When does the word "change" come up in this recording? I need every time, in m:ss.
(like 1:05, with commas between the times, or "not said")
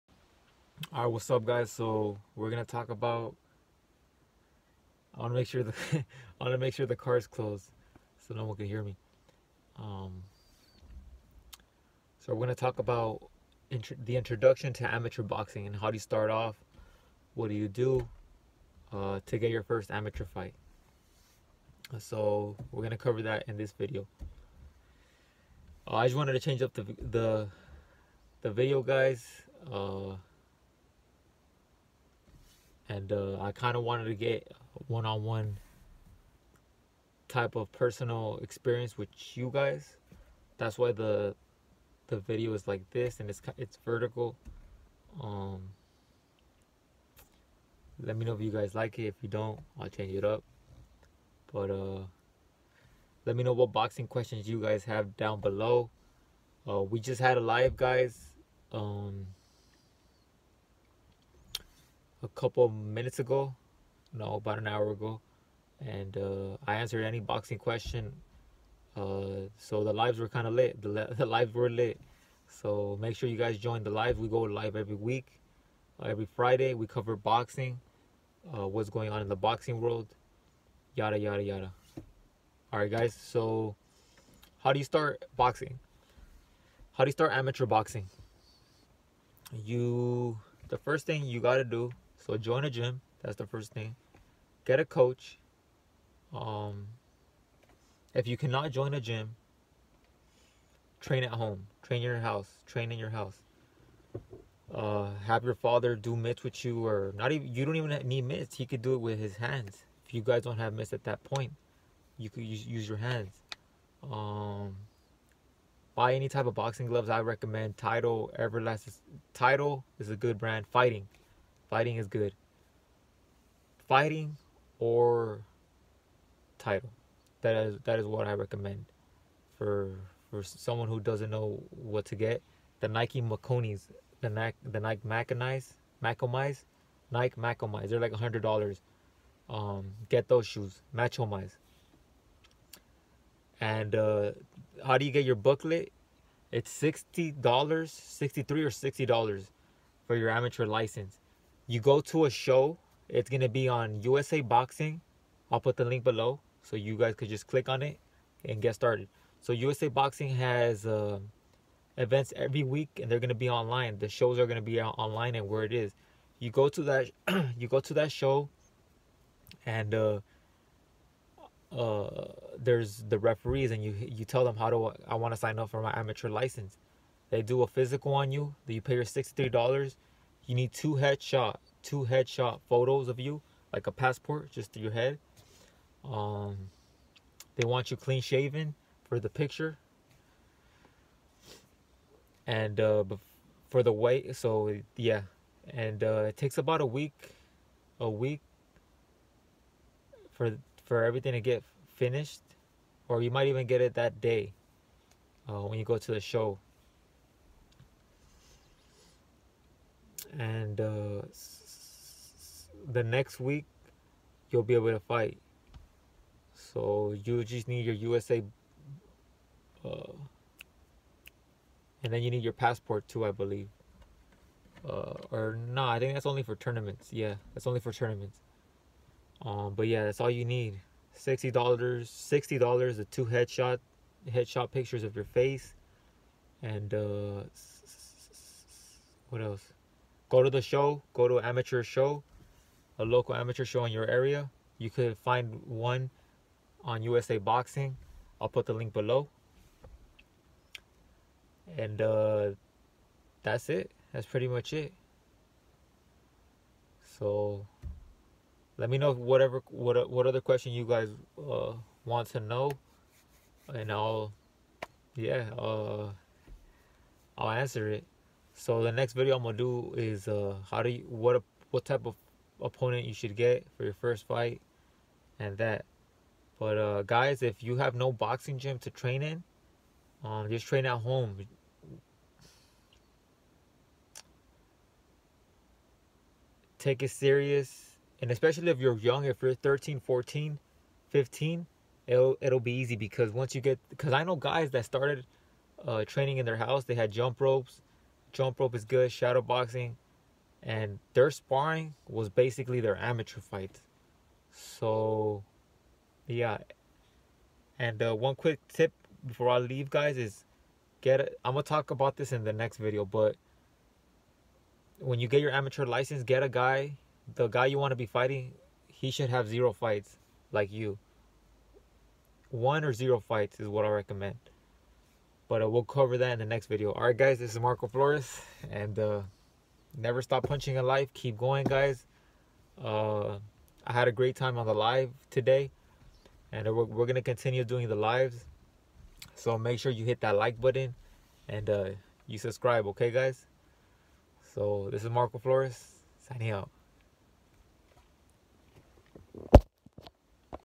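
0:26, 0:49.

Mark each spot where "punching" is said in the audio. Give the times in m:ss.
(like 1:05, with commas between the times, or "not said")
5:30.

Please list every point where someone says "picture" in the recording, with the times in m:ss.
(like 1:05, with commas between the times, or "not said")
3:09, 3:54.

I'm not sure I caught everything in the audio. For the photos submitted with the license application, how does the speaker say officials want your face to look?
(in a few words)
Clean shaven.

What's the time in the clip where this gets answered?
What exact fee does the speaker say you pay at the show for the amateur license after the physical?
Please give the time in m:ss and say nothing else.
2:59.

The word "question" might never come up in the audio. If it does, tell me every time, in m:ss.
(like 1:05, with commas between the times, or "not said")
0:54, 1:07, 4:20.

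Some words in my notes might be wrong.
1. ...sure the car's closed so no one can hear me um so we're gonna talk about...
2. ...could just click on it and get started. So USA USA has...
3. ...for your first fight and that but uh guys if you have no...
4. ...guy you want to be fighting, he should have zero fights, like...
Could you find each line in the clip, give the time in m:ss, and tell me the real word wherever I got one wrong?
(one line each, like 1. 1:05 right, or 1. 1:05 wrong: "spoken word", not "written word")
1. 0:06 right
2. 2:37 wrong: "Boxing", not "USA"
3. 4:33 right
4. 5:17 right.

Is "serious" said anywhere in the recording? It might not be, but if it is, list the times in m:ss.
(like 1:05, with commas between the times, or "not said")
4:47.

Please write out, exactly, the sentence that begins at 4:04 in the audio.
You could find one on USA Boxing.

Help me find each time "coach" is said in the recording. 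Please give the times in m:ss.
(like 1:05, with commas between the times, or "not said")
1:34.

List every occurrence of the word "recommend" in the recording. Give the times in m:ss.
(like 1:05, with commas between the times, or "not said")
1:57, 2:08, 5:23.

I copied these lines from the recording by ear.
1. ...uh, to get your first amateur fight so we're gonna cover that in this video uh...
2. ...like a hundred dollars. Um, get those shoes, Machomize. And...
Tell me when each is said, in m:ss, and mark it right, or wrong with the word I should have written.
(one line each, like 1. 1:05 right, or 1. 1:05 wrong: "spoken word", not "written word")
1. 0:18 right
2. 2:18 right.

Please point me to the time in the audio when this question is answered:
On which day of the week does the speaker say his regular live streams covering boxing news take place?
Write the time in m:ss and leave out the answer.
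1:16.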